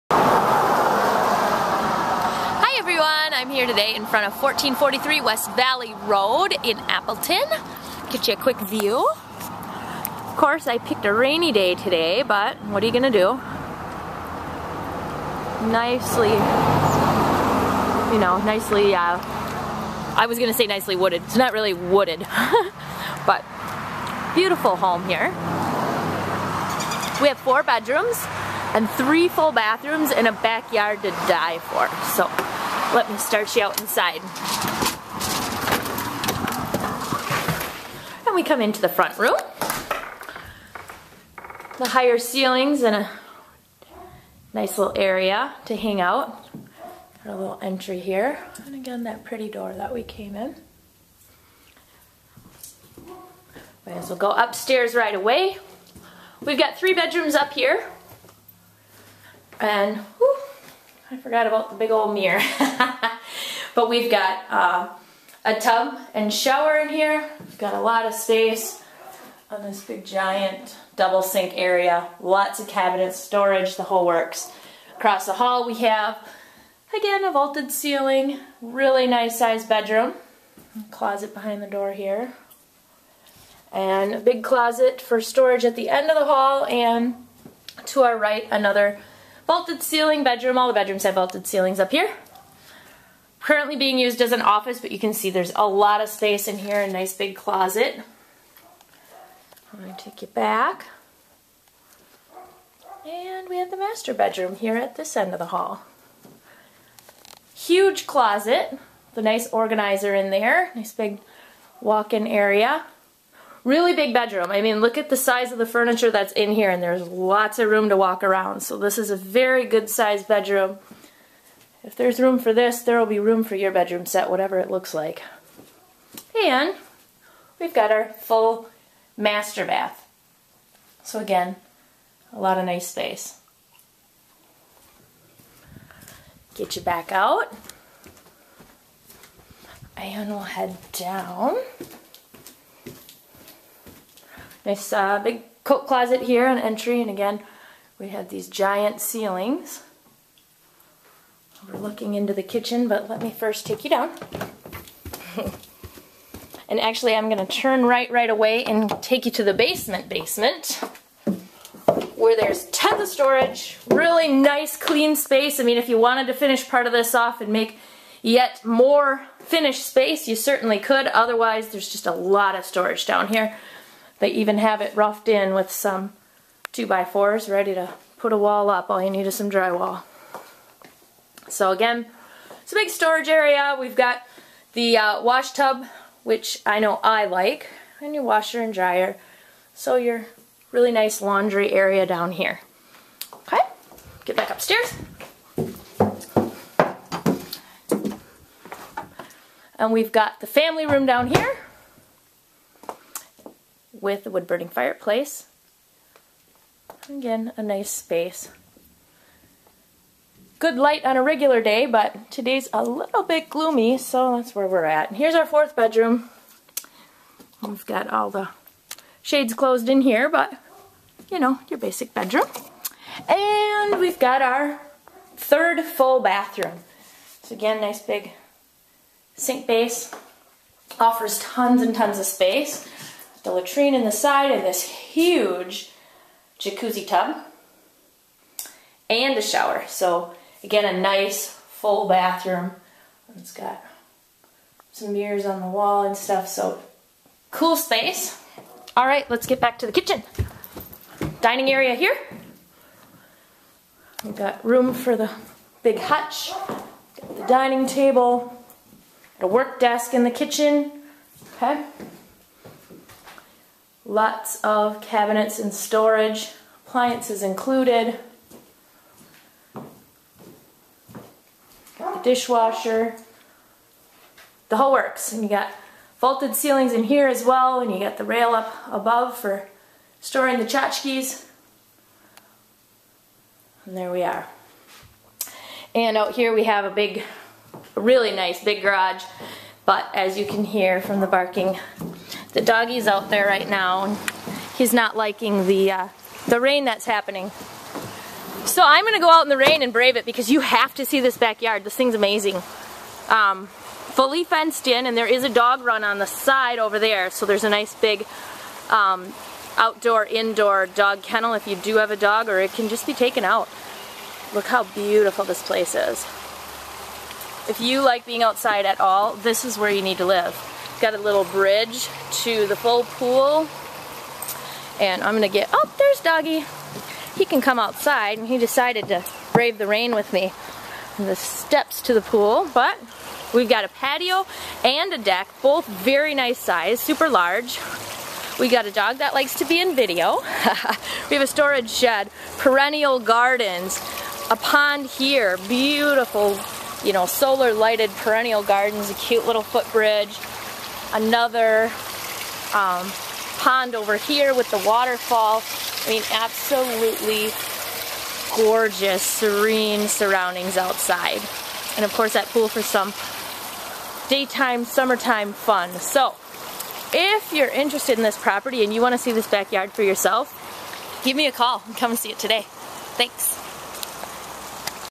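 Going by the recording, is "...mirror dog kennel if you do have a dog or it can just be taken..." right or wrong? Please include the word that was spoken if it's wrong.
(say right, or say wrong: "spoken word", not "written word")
wrong: "indoor", not "mirror".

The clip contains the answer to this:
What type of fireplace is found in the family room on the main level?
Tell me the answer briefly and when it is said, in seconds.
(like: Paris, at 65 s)
Wood burning, at 204 s.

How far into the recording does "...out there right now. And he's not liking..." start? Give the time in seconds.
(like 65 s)
293 s.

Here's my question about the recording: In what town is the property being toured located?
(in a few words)
Appleton.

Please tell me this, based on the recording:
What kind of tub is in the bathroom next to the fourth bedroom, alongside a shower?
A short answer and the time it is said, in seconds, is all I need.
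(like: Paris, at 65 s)
Jacuzzi tub, at 236 s.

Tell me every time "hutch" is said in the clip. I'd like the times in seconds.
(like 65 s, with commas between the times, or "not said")
255 s.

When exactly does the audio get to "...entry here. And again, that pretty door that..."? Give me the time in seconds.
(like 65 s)
47 s.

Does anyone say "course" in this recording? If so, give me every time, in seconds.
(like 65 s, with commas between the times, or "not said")
10 s, 362 s.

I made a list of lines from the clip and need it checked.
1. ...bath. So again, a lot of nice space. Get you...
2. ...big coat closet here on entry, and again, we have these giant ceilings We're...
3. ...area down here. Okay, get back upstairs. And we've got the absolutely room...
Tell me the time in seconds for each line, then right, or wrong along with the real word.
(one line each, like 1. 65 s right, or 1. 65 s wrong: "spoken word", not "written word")
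1. 129 s right
2. 145 s right
3. 191 s wrong: "family", not "absolutely".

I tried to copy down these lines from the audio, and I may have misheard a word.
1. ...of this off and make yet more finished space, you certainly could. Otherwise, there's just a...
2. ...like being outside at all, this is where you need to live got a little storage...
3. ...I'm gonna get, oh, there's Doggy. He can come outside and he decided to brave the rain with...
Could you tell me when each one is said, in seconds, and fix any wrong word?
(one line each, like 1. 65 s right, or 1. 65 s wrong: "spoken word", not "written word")
1. 166 s right
2. 318 s wrong: "bridge", not "storage"
3. 325 s right.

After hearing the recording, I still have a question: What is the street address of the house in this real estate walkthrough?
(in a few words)
1443 West Valley Road.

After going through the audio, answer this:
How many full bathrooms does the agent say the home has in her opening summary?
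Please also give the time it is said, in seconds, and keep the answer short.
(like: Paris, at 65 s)
3, at 28 s.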